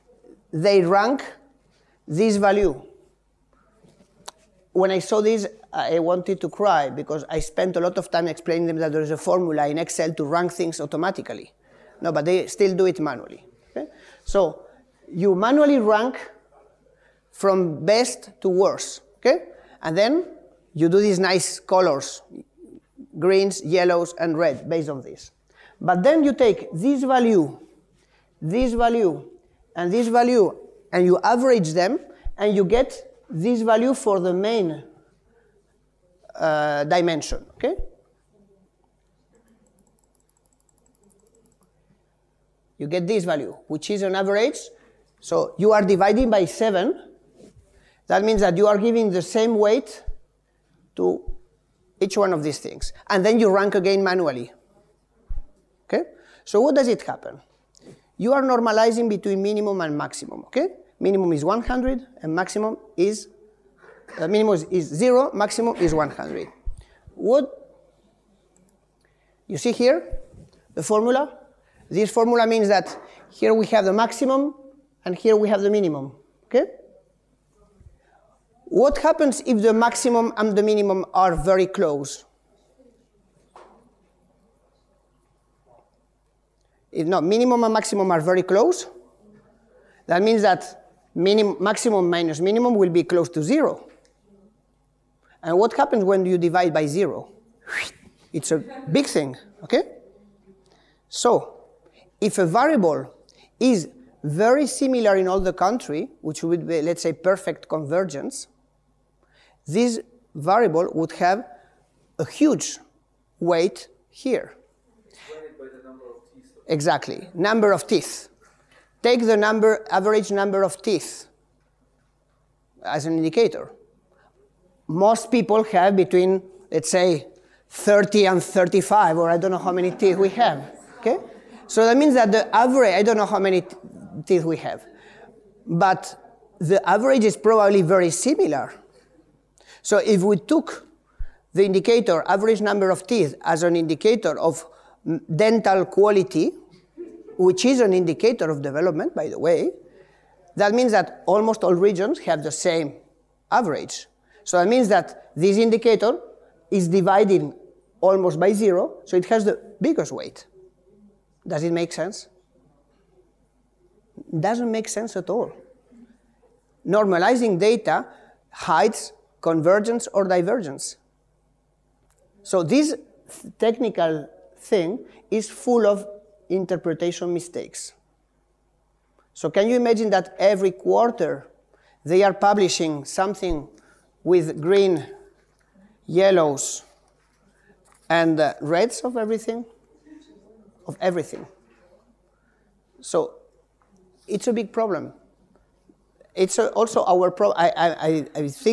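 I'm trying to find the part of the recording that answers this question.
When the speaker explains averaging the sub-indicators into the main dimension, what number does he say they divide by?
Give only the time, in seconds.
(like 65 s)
46 s.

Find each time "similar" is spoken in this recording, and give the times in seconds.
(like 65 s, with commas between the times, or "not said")
104 s, 138 s.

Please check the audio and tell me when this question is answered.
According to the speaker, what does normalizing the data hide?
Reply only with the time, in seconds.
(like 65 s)
169 s.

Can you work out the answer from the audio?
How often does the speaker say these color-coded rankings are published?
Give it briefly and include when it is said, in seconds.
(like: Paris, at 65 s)
Every quarter, at 180 s.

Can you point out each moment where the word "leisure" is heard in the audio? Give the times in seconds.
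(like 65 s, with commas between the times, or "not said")
not said.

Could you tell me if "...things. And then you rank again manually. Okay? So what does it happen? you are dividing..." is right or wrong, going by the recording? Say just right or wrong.
wrong.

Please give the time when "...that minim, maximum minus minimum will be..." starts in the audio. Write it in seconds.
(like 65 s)
90 s.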